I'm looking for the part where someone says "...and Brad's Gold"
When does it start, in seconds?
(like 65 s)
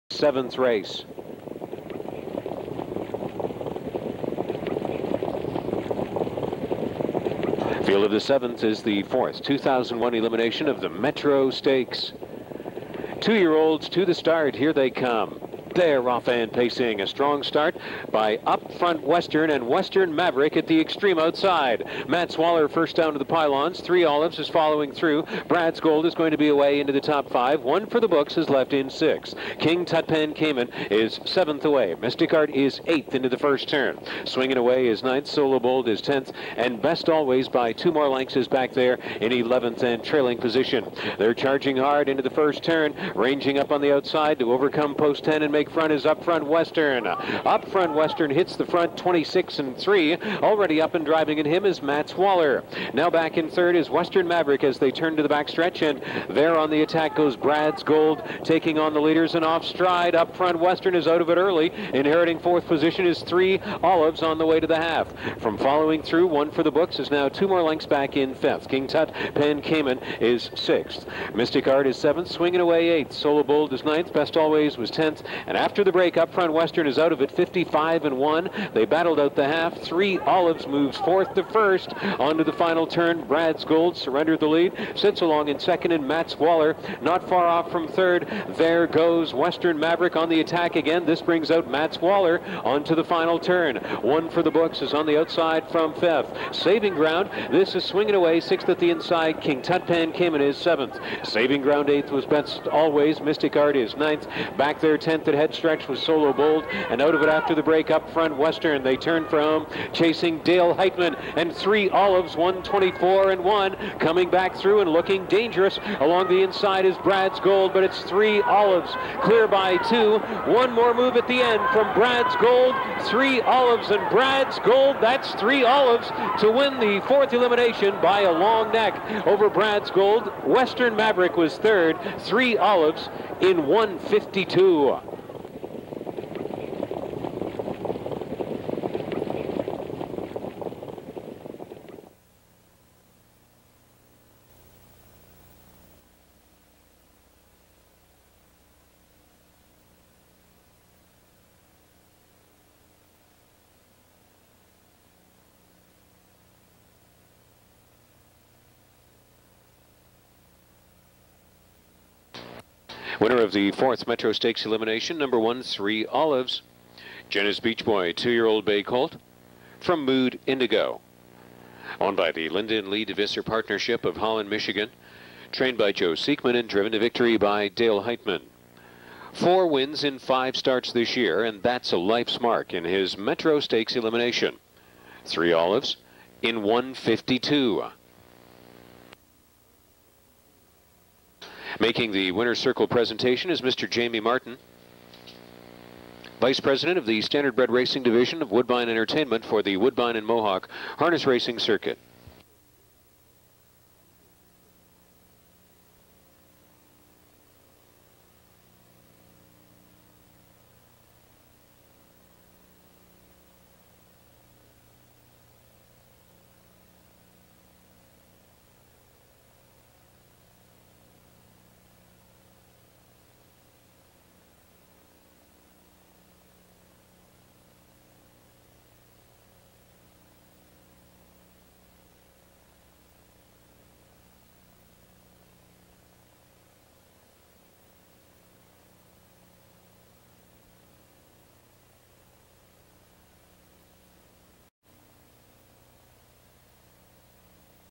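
123 s.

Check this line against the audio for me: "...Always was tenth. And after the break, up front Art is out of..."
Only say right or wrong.
wrong.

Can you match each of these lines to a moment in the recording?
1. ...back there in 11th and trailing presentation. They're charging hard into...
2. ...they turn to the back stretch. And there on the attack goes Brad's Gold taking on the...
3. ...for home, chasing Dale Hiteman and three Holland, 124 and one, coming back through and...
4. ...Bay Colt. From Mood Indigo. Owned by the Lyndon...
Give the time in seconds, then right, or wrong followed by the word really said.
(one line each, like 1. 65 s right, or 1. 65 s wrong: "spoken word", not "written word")
1. 38 s wrong: "position", not "presentation"
2. 54 s right
3. 109 s wrong: "Olives", not "Holland"
4. 168 s right.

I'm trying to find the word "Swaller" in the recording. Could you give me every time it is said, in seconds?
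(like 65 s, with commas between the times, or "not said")
22 s, 52 s.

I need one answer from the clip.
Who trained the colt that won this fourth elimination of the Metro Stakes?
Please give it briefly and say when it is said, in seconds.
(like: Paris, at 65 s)
Joe Siekman, at 175 s.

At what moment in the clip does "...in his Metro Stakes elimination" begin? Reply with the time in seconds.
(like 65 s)
182 s.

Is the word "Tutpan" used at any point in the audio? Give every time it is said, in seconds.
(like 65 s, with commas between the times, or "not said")
29 s, 99 s.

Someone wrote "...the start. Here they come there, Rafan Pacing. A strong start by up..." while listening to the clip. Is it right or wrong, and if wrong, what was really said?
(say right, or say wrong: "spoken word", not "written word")
right.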